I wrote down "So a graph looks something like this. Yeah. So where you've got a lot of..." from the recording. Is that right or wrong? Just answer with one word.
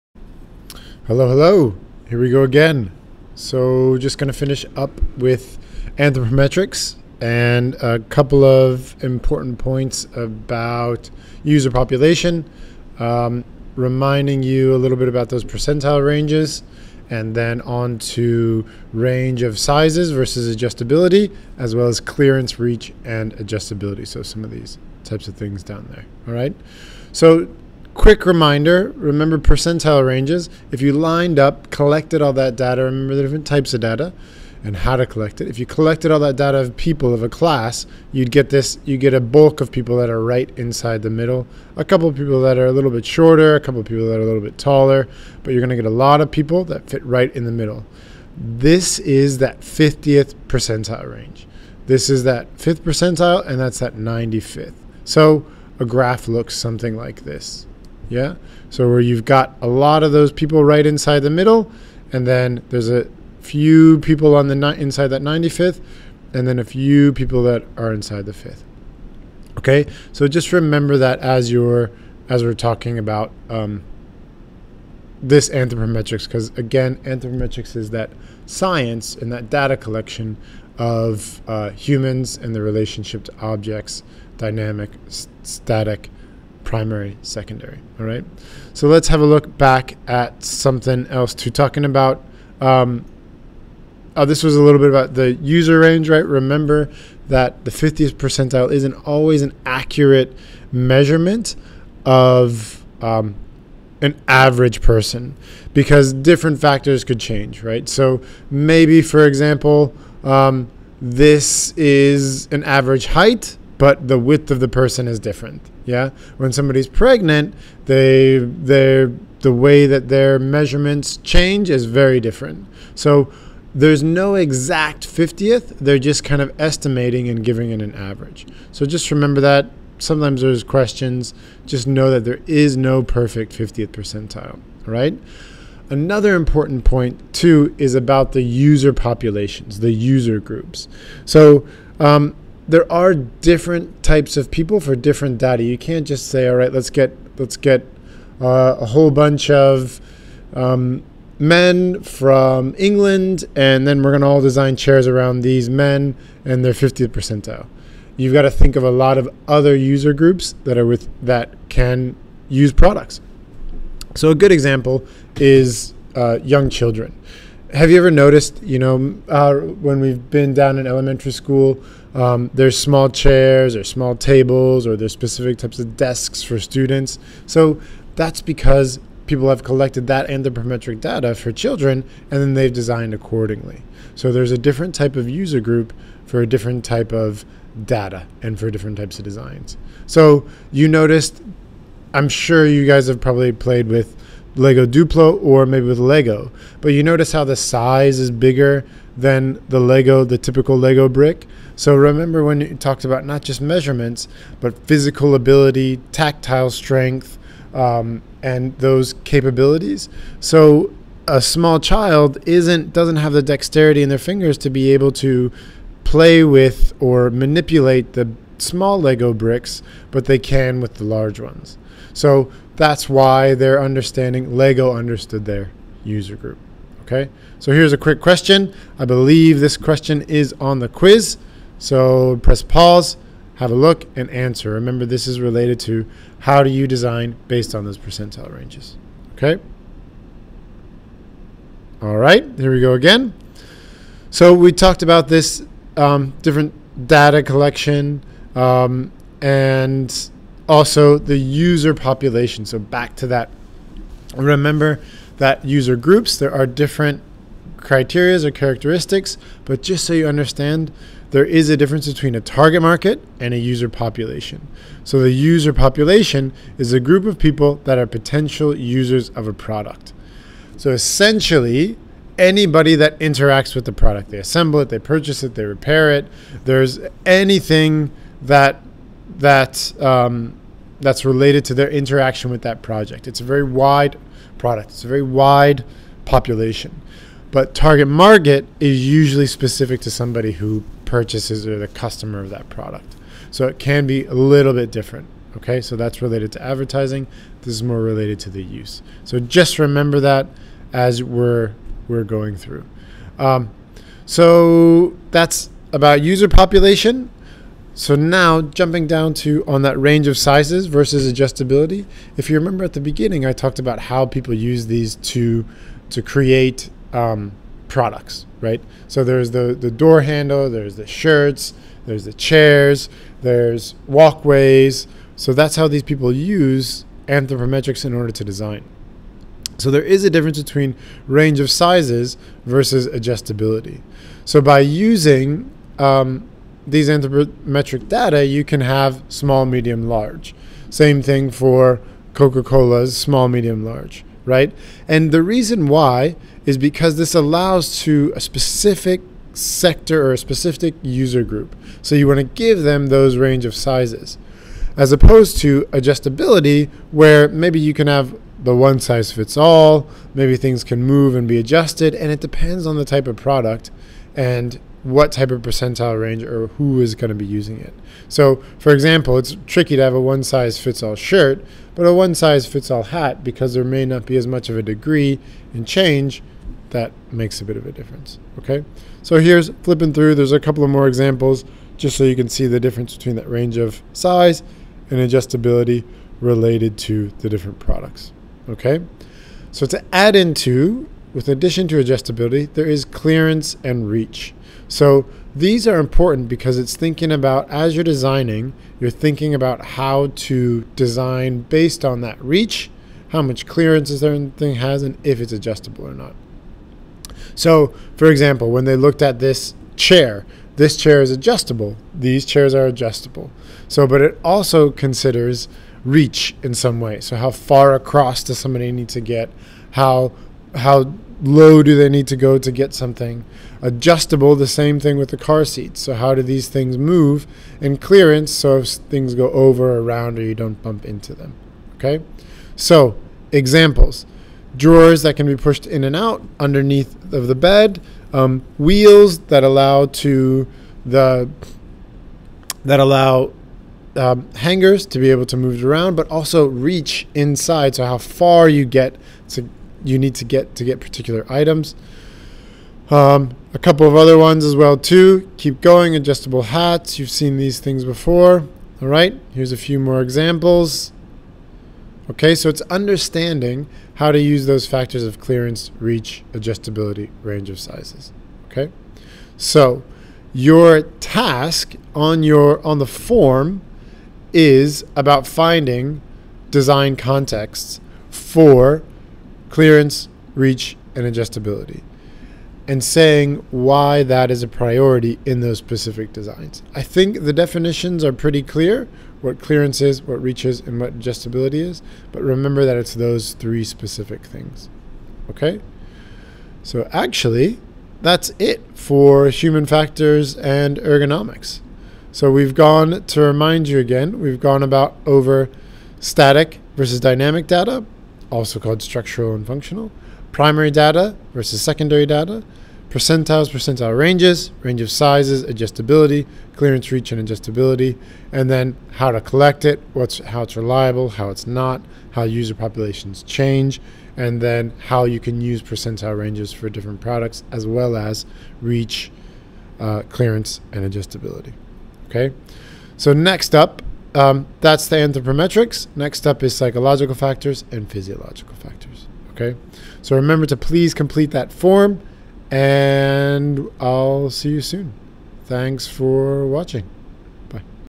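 right.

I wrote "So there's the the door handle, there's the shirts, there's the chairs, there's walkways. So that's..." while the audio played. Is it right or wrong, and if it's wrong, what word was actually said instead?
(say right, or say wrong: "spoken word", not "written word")
right.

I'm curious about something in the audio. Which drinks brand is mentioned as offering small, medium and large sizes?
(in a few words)
Coca-Cola.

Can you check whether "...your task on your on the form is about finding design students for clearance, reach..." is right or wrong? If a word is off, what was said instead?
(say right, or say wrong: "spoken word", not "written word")
wrong: "contexts", not "students".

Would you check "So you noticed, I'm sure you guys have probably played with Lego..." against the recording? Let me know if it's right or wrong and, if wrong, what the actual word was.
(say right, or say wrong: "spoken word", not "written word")
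right.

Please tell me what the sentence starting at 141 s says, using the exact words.
So, um, there are different types of people for different data.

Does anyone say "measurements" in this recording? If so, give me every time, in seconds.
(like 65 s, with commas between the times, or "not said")
100 s, 120 s, 203 s.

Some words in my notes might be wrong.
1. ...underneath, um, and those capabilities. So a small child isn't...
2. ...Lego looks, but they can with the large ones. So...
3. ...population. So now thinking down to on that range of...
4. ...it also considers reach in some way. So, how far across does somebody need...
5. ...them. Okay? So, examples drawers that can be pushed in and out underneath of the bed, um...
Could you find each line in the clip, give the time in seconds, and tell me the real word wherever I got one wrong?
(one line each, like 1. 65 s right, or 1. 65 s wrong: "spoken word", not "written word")
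1. 206 s wrong: "strength", not "underneath"
2. 219 s wrong: "bricks", not "looks"
3. 306 s wrong: "jumping", not "thinking"
4. 414 s right
5. 431 s right.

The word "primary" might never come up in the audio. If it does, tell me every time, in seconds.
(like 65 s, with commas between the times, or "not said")
86 s, 510 s.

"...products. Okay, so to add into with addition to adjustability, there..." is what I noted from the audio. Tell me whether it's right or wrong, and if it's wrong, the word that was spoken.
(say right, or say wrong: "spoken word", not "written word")
right.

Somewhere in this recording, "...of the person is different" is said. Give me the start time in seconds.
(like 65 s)
114 s.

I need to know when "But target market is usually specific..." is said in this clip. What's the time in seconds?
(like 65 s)
287 s.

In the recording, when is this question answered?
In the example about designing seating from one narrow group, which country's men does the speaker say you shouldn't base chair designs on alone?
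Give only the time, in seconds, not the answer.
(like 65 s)
152 s.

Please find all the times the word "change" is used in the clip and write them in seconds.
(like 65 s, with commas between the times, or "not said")
107 s, 121 s, 375 s, 523 s.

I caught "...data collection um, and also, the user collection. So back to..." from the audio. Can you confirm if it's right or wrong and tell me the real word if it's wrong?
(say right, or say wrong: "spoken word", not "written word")
wrong: "population", not "collection".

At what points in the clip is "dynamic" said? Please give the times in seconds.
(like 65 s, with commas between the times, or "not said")
84 s, 507 s.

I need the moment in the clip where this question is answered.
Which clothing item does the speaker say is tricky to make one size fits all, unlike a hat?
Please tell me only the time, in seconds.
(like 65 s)
371 s.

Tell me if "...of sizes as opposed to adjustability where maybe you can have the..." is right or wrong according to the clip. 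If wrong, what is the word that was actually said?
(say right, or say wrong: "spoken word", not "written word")
right.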